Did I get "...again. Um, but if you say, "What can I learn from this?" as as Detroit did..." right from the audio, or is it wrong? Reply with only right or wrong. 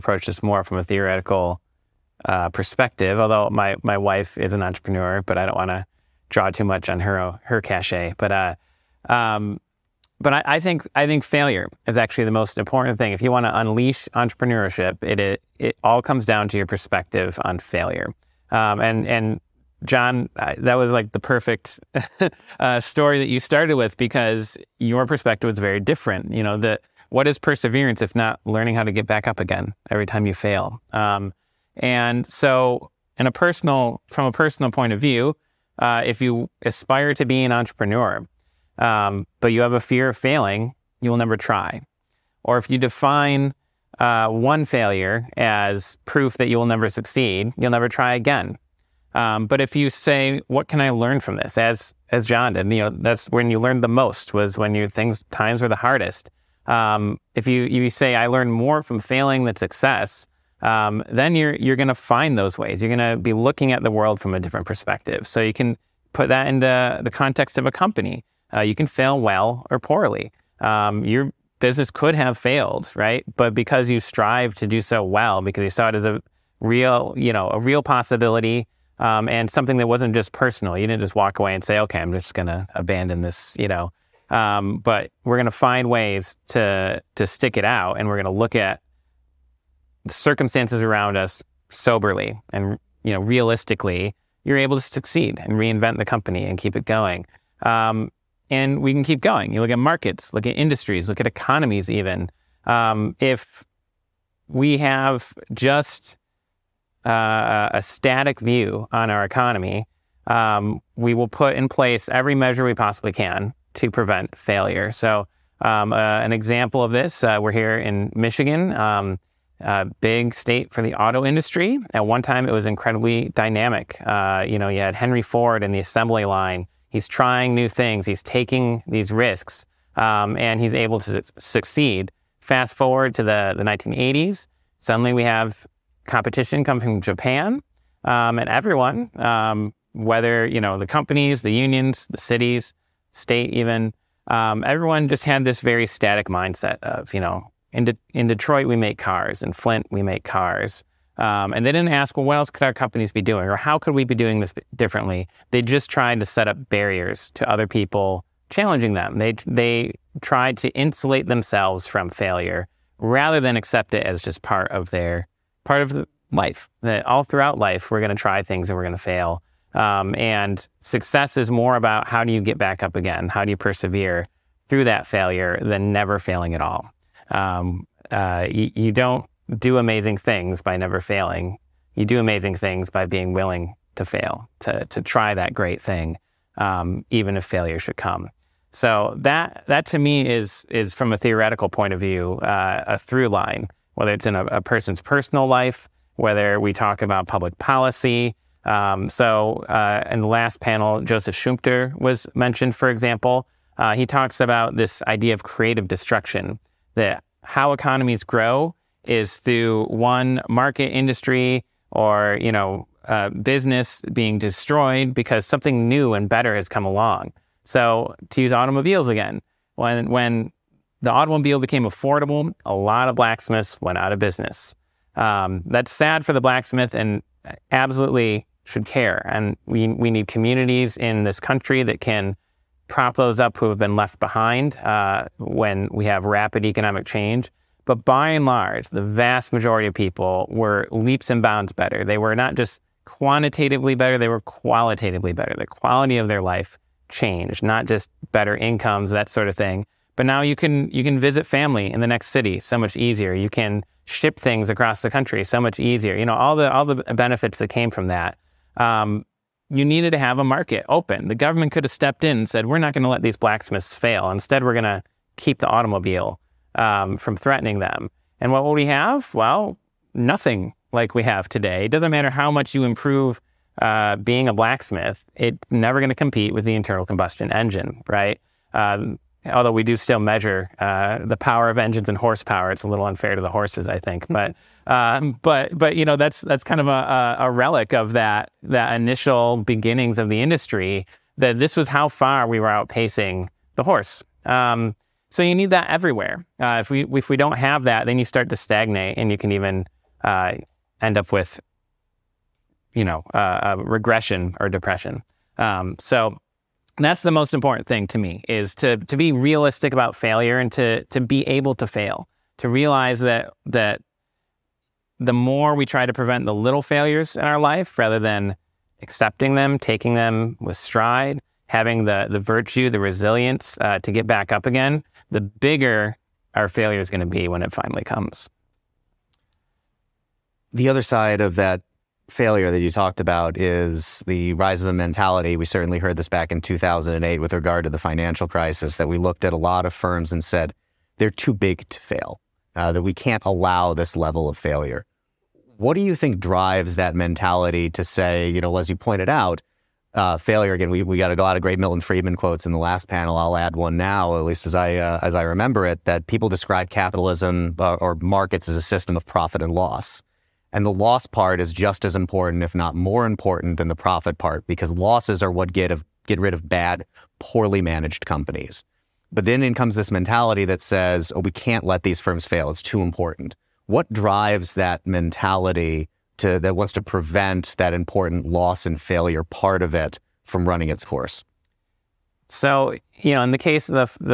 wrong.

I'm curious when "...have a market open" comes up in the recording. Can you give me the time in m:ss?
4:20.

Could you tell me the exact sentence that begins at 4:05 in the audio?
The quality of their life changed, not just better incomes, that sort of thing.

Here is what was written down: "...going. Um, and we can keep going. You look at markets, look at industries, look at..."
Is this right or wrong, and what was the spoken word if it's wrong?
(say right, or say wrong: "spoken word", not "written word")
right.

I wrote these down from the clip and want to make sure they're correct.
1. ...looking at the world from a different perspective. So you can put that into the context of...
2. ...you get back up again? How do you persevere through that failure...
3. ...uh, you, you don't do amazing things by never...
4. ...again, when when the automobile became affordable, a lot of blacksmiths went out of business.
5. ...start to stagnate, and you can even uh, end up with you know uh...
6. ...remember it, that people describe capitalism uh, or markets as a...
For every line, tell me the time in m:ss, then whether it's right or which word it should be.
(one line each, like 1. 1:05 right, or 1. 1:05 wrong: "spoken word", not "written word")
1. 1:03 right
2. 2:52 right
3. 2:58 right
4. 3:39 right
5. 4:58 right
6. 5:55 right.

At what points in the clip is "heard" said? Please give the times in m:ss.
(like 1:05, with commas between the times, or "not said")
5:35.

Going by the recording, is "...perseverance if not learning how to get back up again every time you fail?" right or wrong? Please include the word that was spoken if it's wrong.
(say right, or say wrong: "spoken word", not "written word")
right.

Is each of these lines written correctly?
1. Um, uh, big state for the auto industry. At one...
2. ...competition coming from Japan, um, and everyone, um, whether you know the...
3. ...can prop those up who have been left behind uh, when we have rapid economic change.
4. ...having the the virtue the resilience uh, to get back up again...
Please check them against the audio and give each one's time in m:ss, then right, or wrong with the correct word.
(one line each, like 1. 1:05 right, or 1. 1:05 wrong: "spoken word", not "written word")
1. 1:58 right
2. 2:16 right
3. 3:52 right
4. 5:21 right.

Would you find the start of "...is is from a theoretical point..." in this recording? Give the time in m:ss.
3:10.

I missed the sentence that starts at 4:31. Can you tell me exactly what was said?
It doesn't matter how much you improve uh, being a blacksmith, it's never going to compete with the internal combustion engine, right?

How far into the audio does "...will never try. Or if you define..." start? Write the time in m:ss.
0:41.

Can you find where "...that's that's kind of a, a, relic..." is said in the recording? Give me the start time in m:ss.
4:46.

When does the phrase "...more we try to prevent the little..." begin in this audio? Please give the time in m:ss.
5:15.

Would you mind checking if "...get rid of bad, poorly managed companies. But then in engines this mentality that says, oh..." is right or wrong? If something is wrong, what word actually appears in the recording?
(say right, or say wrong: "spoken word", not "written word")
wrong: "comes", not "engines".